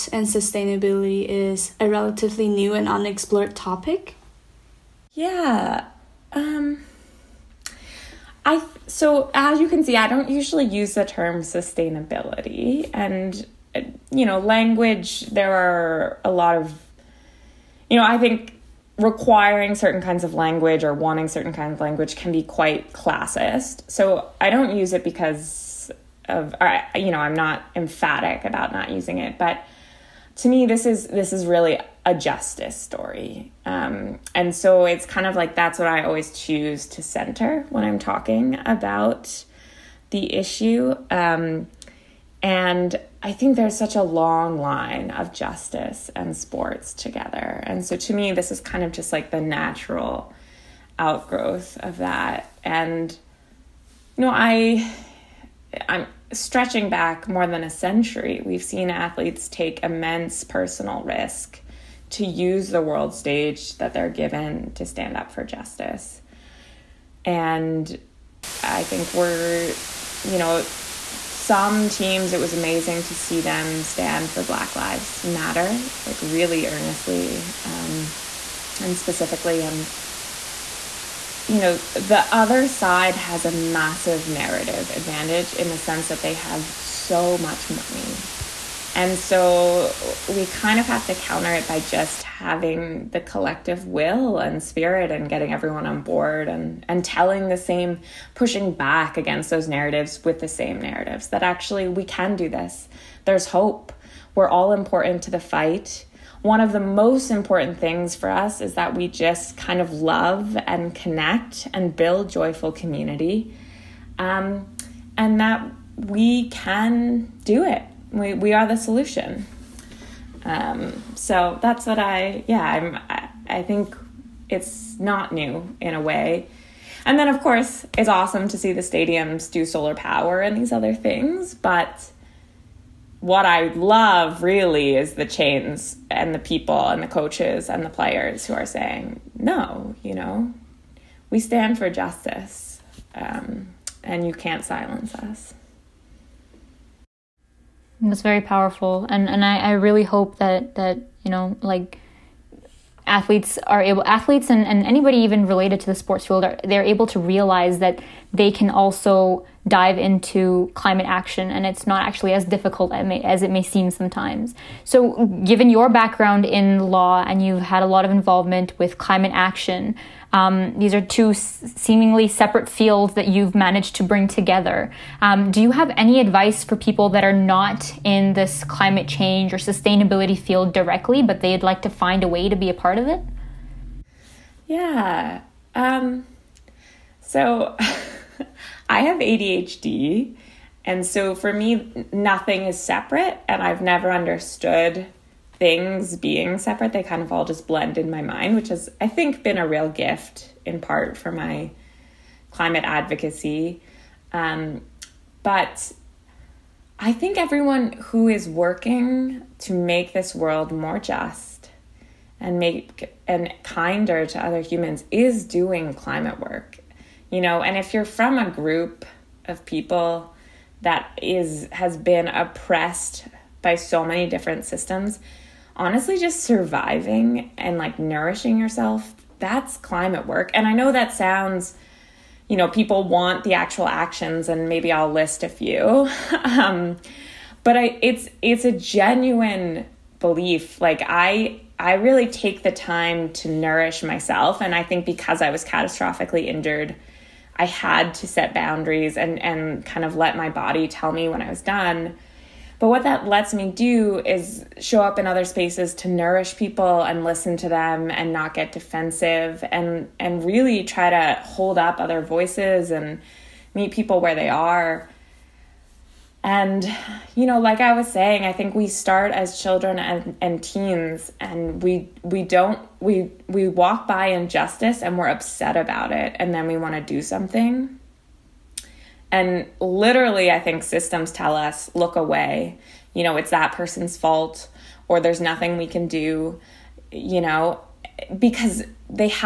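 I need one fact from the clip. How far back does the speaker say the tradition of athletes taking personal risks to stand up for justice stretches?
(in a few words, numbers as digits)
more than a century.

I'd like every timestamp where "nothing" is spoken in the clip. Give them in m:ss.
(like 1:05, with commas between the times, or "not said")
3:12, 4:45.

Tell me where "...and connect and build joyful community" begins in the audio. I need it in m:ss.
1:50.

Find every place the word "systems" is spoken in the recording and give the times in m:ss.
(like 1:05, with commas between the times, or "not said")
3:44, 4:40.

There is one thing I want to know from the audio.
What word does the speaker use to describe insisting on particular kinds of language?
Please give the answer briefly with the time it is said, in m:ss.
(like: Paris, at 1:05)
classist, at 0:22.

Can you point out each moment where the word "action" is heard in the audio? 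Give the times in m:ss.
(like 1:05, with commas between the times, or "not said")
2:41, 2:49, 3:53.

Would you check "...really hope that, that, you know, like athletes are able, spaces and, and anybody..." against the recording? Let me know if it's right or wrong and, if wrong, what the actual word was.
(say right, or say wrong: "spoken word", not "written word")
wrong: "athletes", not "spaces".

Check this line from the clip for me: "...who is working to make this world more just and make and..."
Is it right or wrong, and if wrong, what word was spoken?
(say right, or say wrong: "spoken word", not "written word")
right.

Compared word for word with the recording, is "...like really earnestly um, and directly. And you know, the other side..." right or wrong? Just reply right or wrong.
wrong.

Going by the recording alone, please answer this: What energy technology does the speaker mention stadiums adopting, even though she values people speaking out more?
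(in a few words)
solar power.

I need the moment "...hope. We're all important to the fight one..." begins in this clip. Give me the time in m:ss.
1:43.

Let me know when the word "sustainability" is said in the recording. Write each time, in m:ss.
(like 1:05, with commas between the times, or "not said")
0:00, 0:11, 2:59.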